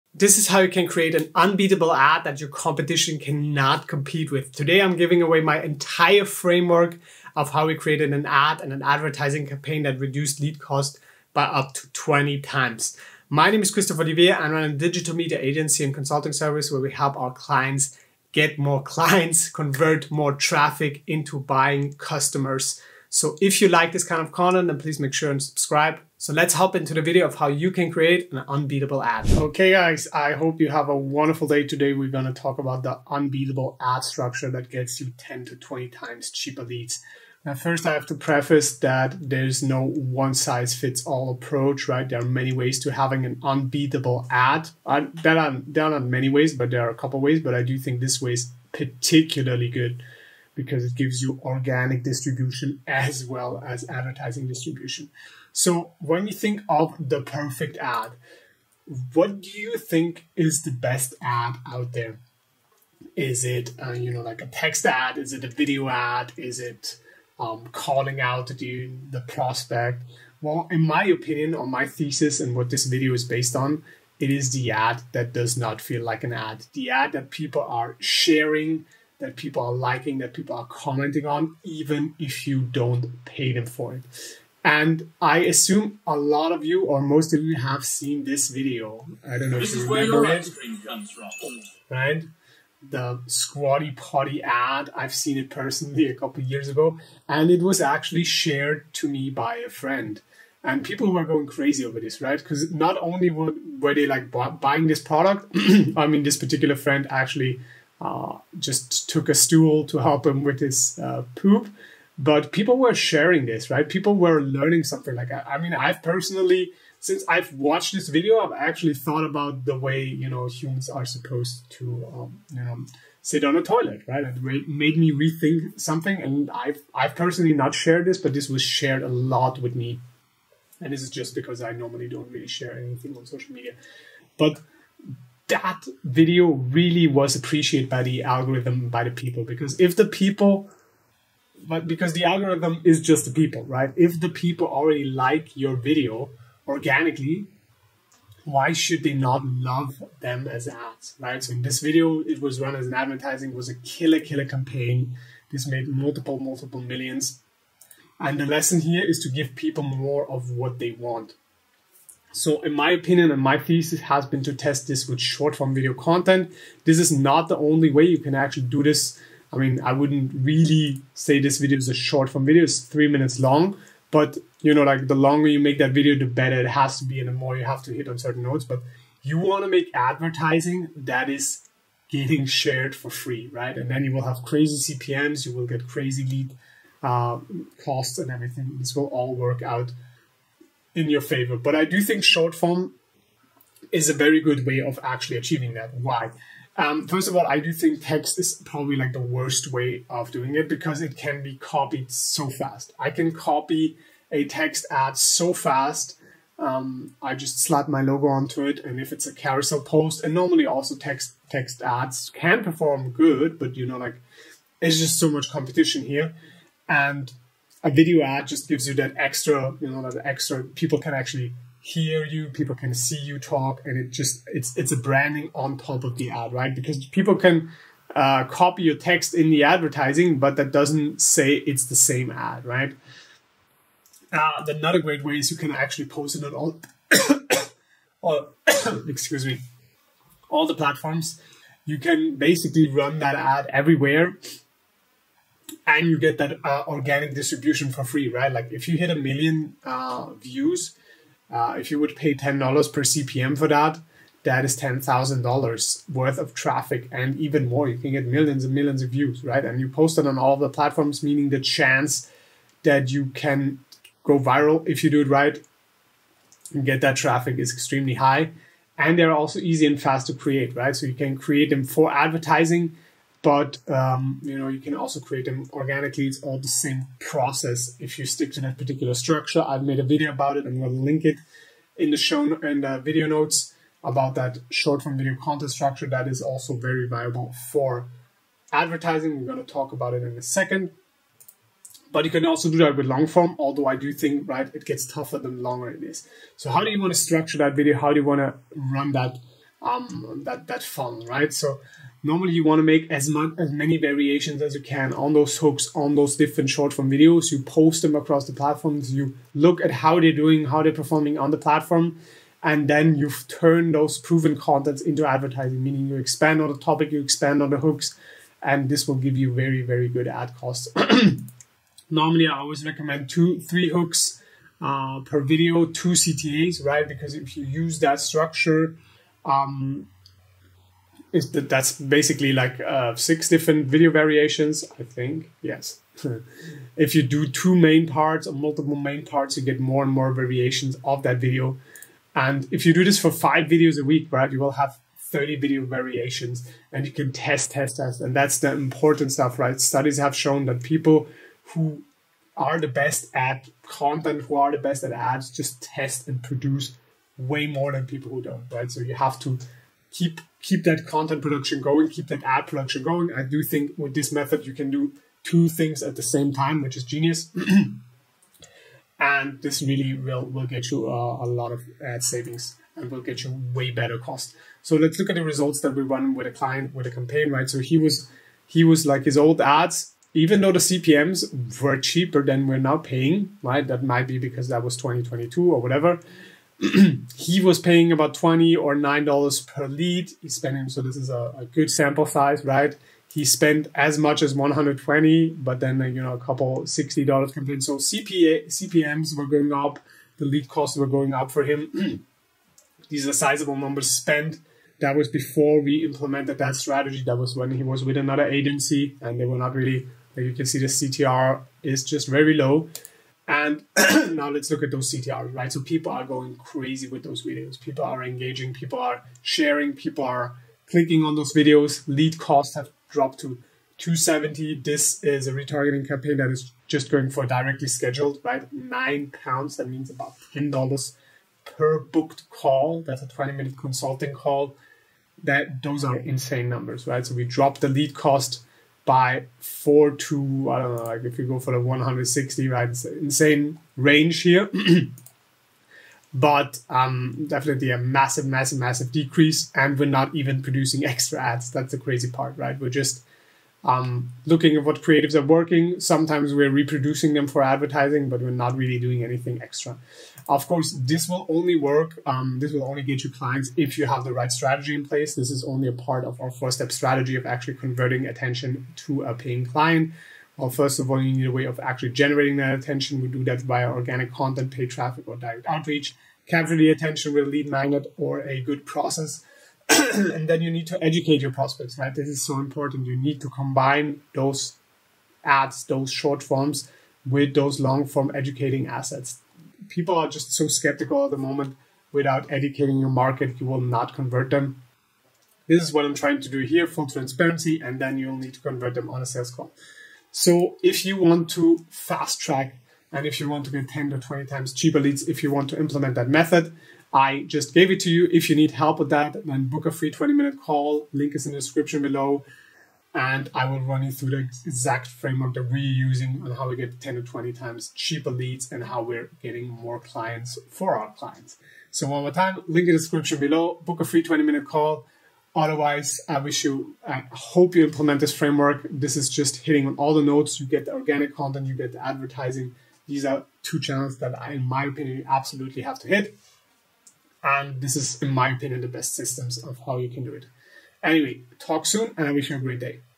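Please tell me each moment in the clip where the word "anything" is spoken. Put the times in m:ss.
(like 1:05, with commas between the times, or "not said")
2:12, 7:39.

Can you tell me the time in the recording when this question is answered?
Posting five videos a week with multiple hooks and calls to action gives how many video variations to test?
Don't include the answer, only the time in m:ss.
5:45.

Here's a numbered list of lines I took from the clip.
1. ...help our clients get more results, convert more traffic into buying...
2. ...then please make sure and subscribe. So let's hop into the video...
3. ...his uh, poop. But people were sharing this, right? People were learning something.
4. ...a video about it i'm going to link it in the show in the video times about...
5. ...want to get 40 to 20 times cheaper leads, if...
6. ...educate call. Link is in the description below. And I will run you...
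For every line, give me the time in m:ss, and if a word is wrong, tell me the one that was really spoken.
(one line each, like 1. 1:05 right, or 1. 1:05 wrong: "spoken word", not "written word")
1. 0:16 wrong: "clients", not "results"
2. 0:24 right
3. 1:50 right
4. 4:39 wrong: "notes", not "times"
5. 8:23 wrong: "10", not "40"
6. 8:30 wrong: "minute", not "educate".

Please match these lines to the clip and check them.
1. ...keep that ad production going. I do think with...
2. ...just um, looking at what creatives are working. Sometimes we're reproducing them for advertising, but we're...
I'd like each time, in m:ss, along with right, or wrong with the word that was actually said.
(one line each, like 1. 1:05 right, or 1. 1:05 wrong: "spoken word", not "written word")
1. 6:02 right
2. 7:32 right.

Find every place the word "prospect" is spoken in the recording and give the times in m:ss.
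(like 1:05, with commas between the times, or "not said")
1:09, 8:01.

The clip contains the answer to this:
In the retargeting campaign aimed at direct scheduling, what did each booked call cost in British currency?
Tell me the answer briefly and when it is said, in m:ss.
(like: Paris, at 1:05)
9 pounds, at 7:08.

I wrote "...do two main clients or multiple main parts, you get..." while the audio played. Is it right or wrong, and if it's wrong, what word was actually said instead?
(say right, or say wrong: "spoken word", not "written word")
wrong: "parts", not "clients".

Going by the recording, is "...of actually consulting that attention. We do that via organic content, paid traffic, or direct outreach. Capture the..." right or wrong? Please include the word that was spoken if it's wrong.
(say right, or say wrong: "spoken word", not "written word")
wrong: "generating", not "consulting".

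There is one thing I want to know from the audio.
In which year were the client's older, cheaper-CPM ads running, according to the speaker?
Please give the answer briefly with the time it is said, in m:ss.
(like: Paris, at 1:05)
2022, at 6:24.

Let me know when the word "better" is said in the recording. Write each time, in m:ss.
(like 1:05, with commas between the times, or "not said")
2:56, 6:13.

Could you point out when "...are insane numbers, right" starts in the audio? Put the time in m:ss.
7:16.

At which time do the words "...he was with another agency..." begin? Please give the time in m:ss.
6:47.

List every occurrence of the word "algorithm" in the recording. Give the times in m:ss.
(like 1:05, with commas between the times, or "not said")
2:18, 2:22.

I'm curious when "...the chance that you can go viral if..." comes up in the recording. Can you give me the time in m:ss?
4:21.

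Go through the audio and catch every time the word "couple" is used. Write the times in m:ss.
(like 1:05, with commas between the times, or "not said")
0:46, 1:36, 6:36.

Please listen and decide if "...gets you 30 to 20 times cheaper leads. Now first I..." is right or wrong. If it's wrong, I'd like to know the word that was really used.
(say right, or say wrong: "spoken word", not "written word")
wrong: "10", not "30".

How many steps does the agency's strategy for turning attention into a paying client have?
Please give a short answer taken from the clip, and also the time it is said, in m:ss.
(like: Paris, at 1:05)
4, at 7:46.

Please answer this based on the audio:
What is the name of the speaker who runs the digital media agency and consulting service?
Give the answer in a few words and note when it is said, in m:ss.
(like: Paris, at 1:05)
Christoph Olivier, at 0:13.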